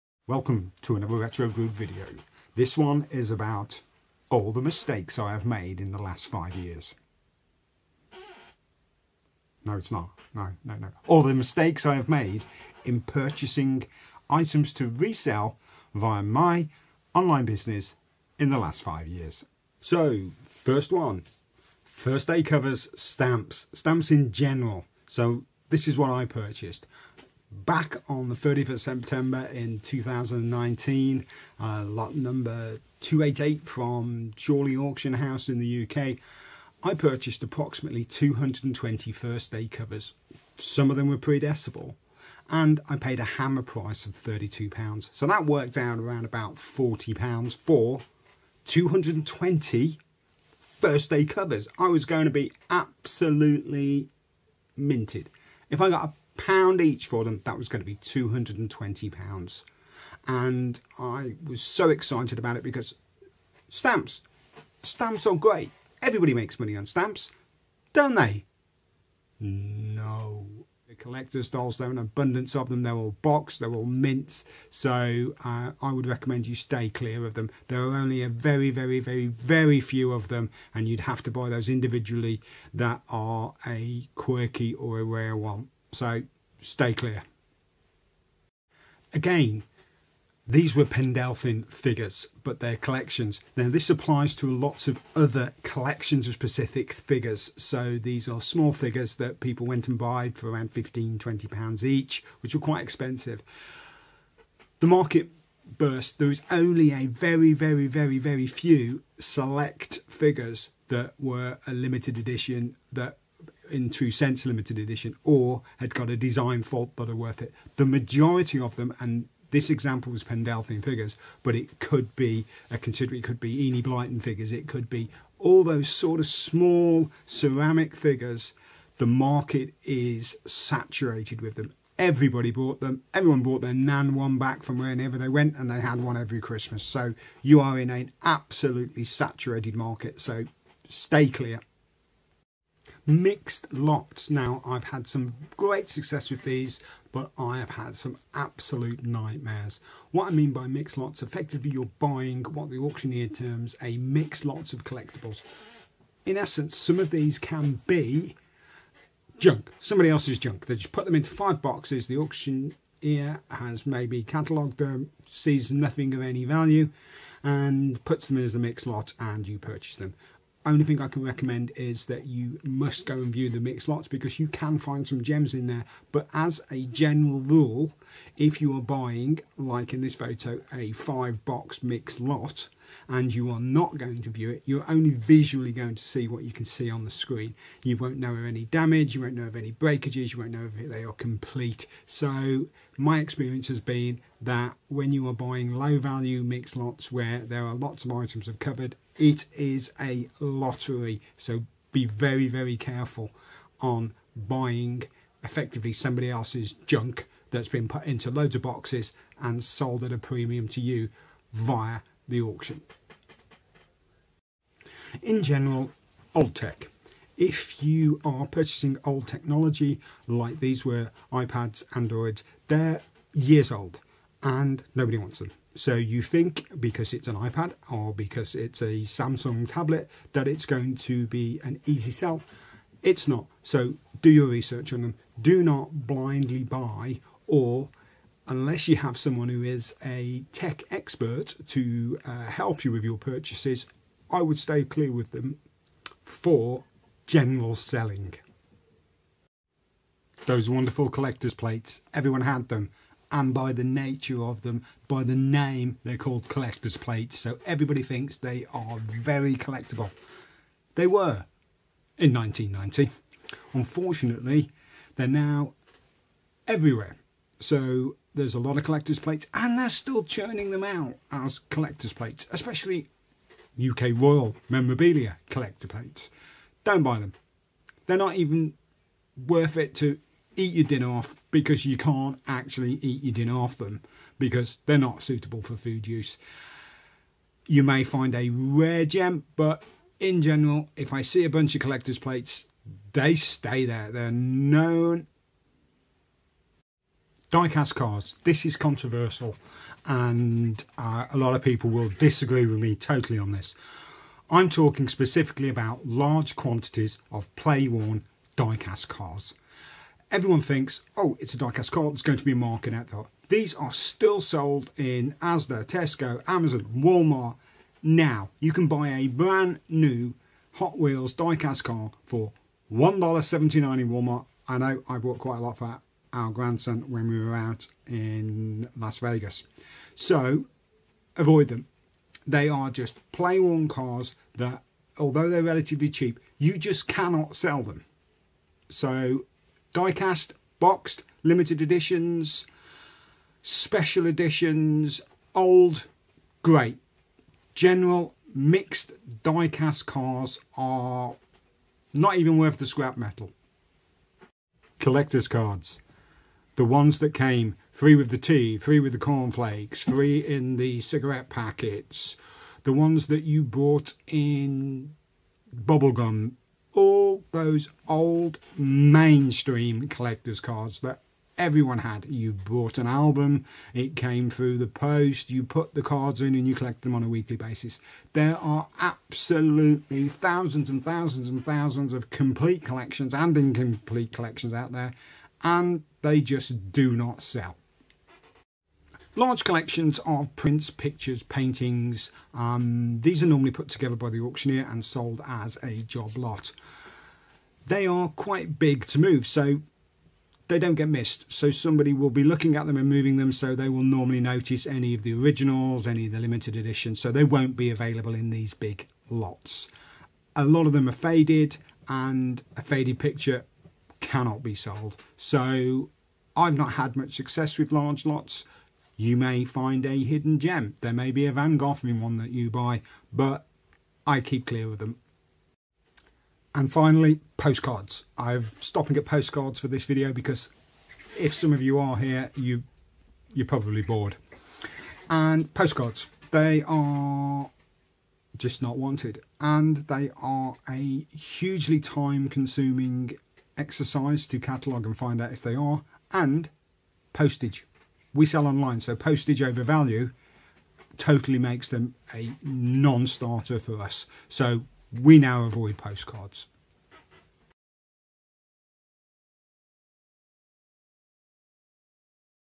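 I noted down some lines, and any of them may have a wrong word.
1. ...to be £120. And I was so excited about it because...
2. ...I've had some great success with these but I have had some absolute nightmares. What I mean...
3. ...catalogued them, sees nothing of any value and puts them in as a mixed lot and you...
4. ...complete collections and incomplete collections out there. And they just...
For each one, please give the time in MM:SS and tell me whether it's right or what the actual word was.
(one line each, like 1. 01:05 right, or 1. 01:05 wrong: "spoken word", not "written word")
1. 00:57 wrong: "220", not "120"
2. 02:24 right
3. 02:44 right
4. 06:22 right.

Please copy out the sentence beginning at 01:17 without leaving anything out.
There are only a very, very, very, very few of them.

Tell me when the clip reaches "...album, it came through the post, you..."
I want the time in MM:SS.
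06:13.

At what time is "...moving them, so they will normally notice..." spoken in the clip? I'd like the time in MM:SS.
06:43.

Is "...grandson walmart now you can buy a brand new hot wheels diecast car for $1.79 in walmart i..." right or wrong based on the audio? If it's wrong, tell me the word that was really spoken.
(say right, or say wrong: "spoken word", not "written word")
wrong: "amazon", not "grandson".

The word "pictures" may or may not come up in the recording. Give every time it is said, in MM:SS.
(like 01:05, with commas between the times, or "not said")
06:30, 06:53.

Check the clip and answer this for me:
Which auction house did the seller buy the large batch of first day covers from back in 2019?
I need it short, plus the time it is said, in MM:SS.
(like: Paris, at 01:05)
Chorley Auction House, at 00:34.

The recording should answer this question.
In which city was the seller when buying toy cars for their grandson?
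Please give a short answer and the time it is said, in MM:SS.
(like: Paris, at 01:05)
Las Vegas, at 05:28.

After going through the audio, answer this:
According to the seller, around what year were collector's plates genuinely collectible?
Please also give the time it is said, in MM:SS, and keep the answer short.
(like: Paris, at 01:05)
1990, at 04:22.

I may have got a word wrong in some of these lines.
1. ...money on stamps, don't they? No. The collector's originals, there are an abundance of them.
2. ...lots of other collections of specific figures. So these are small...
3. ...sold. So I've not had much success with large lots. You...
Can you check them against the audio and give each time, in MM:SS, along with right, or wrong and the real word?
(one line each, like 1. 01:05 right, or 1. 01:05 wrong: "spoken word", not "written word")
1. 01:06 wrong: "dolls", not "originals"
2. 01:34 right
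3. 06:54 right.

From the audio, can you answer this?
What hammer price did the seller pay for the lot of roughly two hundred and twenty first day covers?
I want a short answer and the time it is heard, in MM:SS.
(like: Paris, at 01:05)
£32, at 00:44.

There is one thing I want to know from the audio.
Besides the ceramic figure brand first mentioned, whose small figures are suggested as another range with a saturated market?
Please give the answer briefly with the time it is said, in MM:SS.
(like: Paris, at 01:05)
Enid Blyton, at 02:03.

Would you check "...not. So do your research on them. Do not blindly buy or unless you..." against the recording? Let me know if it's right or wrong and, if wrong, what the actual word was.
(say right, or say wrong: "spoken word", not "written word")
right.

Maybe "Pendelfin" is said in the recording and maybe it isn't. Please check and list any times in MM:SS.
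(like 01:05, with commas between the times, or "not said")
01:30, 02:00.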